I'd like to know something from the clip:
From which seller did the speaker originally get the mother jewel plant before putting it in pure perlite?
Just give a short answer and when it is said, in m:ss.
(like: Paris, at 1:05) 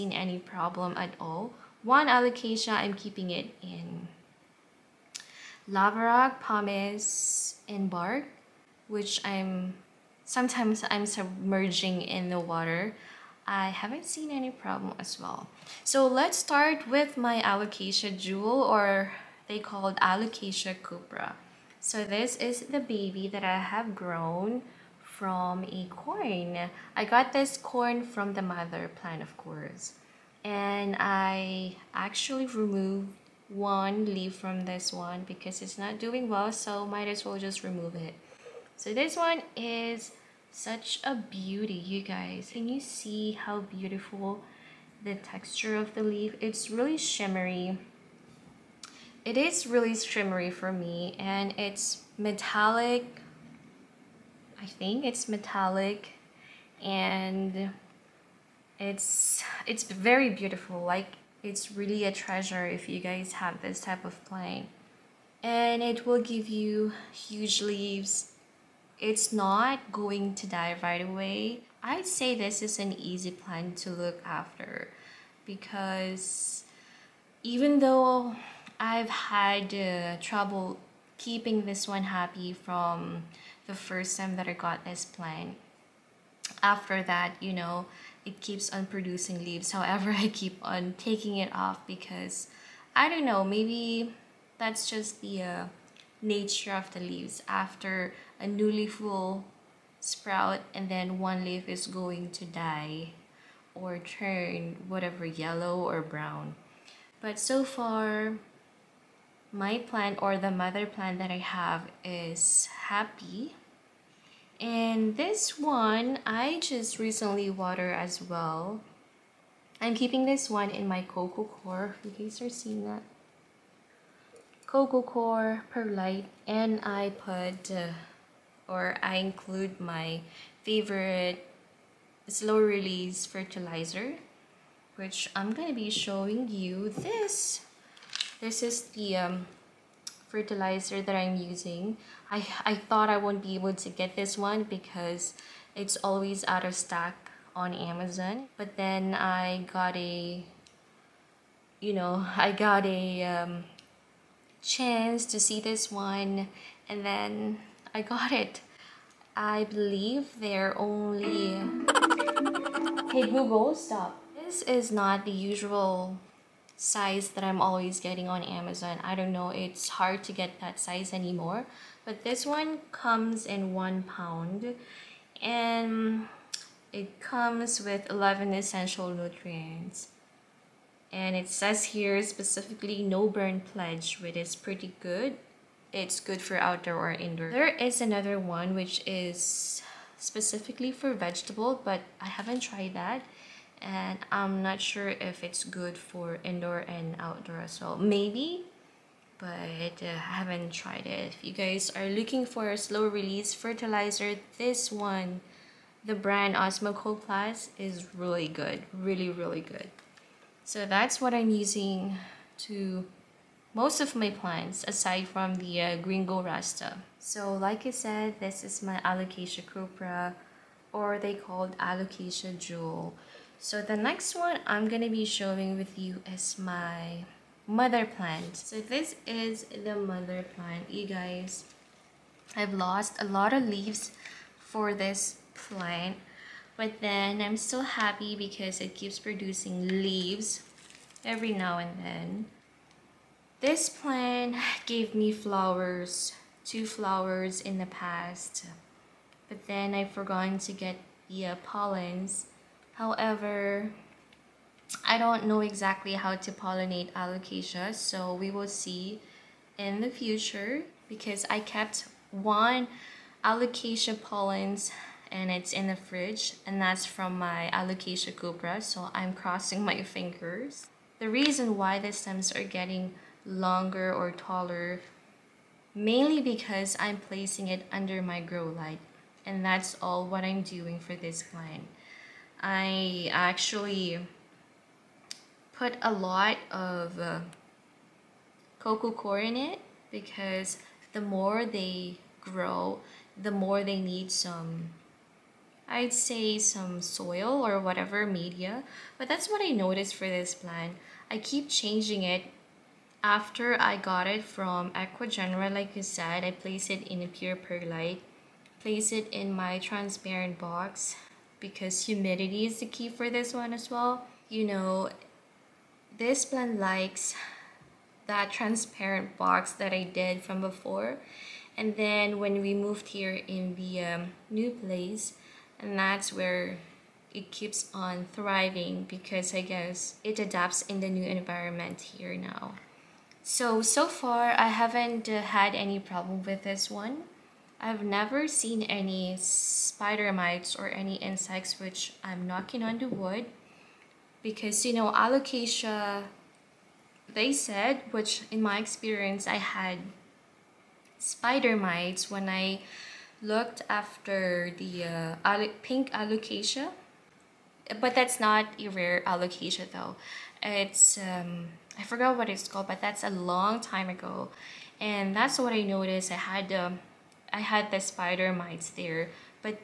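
Aqua Genera, at 5:04.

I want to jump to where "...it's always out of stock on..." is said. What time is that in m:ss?
2:25.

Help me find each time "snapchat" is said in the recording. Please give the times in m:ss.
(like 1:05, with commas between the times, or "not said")
not said.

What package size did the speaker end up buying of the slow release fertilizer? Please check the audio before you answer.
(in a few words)
one pound.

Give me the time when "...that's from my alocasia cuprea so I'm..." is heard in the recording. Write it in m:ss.
4:26.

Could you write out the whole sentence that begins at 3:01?
And it says here specifically no burn pledge, which is pretty good it's good for outdoor or indoor.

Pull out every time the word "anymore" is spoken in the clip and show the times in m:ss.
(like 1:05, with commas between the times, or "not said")
2:51.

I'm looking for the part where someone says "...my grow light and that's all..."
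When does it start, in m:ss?
4:38.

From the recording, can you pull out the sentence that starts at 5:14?
You know, this blend likes that transparent box that I did from before.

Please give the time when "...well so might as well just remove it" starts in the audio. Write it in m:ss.
0:36.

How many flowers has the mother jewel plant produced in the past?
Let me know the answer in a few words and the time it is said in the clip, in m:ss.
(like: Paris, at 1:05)
2, at 4:06.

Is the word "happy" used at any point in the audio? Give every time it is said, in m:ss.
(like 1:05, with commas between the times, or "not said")
1:22, 1:52, 3:57.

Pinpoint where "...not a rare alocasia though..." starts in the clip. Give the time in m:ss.
5:58.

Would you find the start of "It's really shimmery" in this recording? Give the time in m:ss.
0:46.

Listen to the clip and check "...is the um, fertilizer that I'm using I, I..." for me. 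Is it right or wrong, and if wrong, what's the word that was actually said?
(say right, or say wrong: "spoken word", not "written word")
right.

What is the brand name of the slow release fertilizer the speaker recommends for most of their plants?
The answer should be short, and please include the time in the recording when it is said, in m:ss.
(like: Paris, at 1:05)
Osmo Plus, at 3:26.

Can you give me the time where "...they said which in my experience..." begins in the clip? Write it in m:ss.
5:47.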